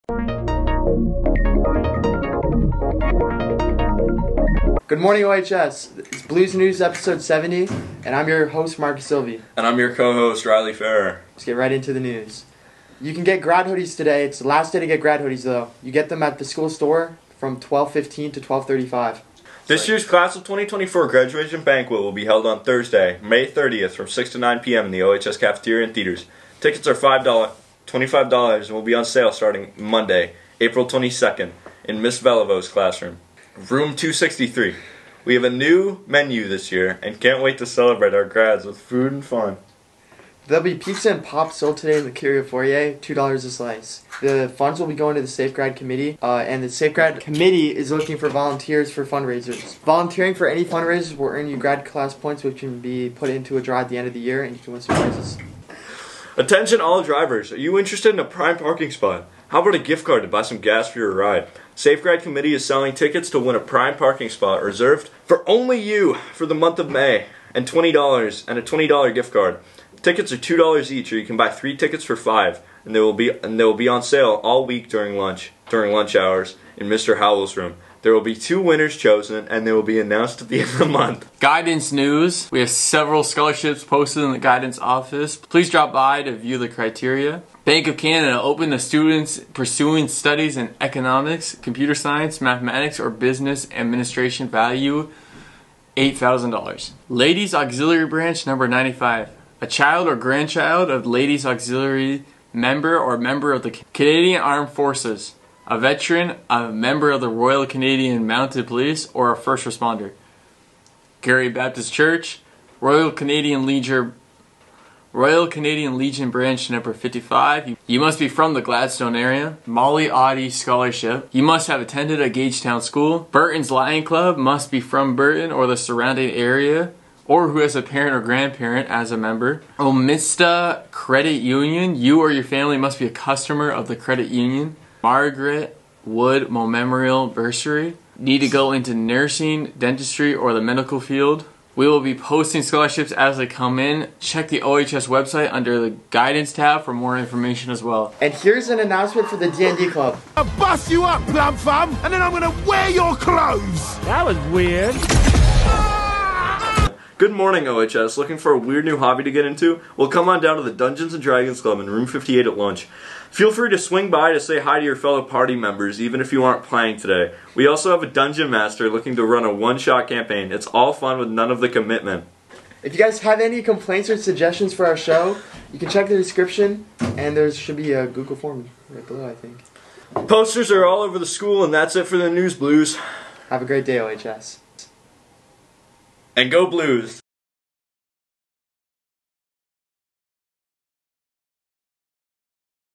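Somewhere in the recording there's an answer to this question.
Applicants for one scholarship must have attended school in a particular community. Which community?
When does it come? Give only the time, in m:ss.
2:02.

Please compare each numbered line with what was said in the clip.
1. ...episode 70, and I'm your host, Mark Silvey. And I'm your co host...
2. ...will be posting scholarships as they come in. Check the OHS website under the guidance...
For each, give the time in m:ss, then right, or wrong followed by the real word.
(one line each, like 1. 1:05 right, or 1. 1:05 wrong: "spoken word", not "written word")
1. 0:06 right
2. 2:21 right.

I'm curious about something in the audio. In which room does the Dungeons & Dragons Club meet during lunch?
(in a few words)
Room 58.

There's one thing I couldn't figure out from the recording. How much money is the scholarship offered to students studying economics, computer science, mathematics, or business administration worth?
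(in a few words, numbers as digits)
$8,000.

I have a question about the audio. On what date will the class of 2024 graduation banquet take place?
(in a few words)
Thursday, May 30th.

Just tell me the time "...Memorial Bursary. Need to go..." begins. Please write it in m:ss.
2:16.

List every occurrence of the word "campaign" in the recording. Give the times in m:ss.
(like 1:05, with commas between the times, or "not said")
2:50.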